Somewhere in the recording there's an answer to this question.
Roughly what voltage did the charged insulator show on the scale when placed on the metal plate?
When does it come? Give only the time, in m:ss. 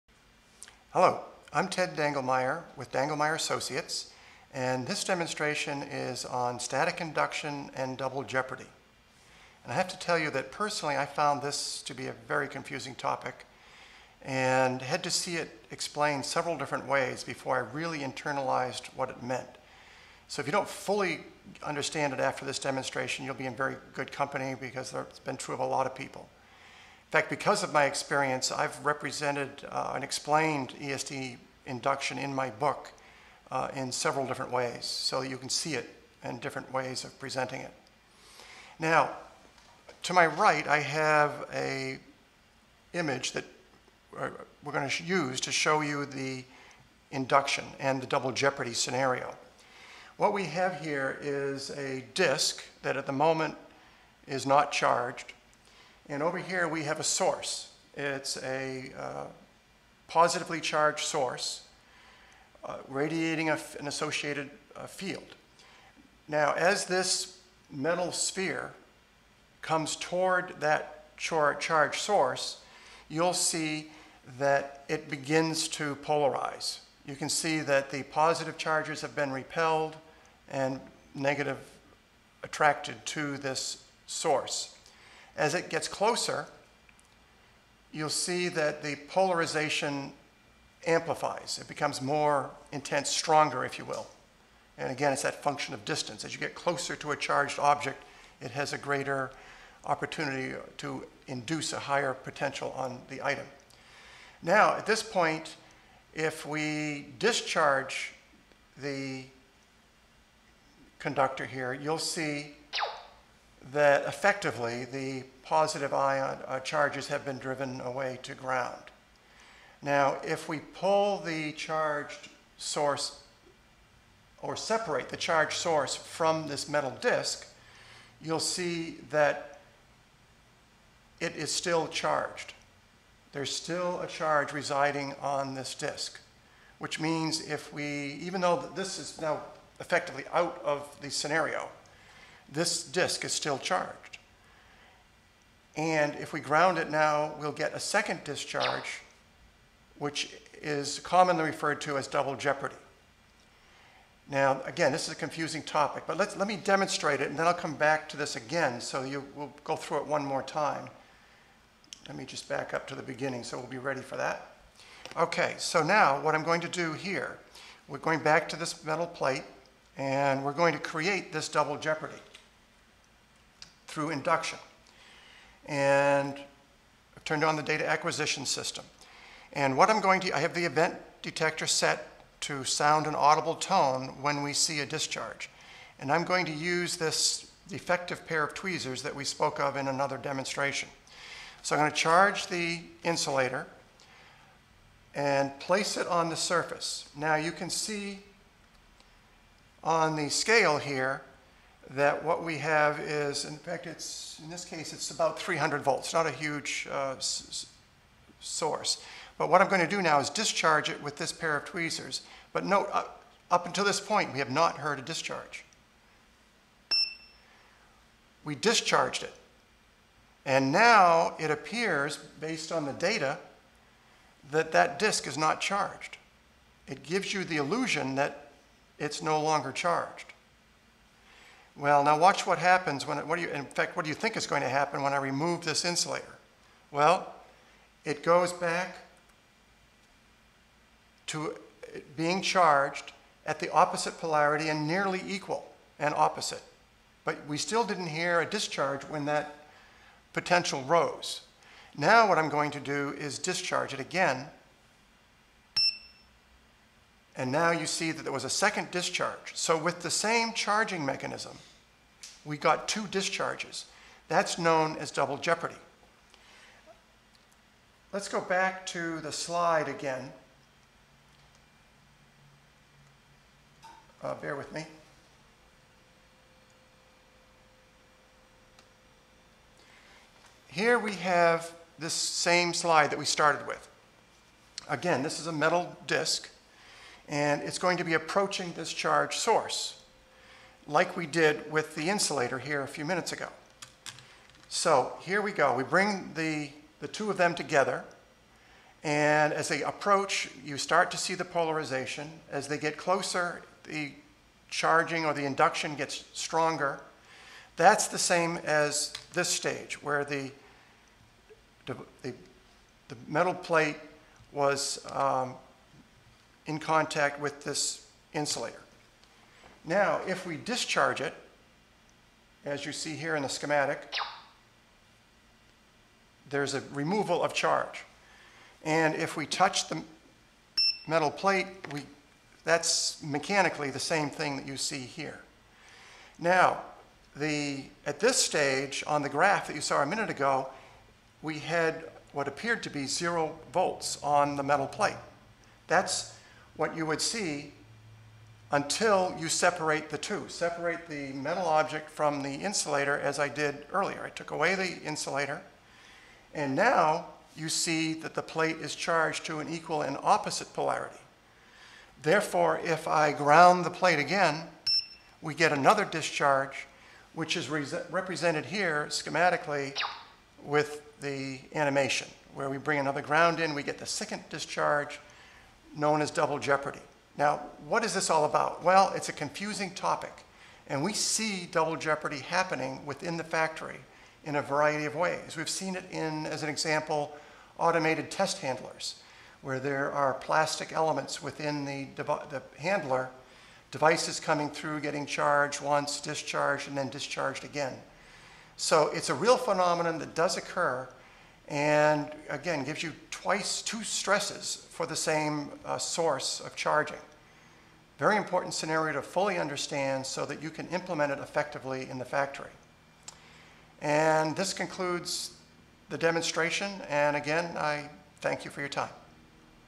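3:25.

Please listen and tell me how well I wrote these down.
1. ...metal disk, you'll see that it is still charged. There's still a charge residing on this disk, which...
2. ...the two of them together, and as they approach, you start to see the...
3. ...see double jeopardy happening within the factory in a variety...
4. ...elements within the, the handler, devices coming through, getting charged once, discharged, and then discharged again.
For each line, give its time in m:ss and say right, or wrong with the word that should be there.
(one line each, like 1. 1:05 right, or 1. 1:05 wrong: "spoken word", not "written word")
1. 2:06 right
2. 4:56 right
3. 6:21 right
4. 6:30 right.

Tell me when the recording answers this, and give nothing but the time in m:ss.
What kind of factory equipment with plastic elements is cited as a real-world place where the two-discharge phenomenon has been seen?
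6:27.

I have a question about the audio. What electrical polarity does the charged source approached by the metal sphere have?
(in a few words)
positively charged.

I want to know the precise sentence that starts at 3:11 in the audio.
So I'm going to charge the insulator and place it on the surface.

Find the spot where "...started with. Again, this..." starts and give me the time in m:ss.
4:43.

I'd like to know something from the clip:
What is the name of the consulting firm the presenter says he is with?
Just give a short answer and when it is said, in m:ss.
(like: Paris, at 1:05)
Dangelmayer Associates, at 0:02.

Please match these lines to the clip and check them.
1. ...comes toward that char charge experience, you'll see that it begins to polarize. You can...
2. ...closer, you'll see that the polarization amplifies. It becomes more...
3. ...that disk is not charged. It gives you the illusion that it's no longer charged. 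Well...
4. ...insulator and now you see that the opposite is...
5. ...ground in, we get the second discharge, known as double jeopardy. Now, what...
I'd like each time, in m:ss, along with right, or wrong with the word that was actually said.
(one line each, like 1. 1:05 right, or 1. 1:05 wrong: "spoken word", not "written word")
1. 1:09 wrong: "source", not "experience"
2. 1:25 right
3. 3:44 right
4. 5:55 wrong: "plate", not "opposite"
5. 6:13 right.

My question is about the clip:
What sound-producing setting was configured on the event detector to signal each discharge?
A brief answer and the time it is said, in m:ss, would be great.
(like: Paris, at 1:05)
audible tone, at 3:03.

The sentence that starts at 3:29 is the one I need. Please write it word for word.
But what I'm going to do now is discharge it with this pair of tweezers.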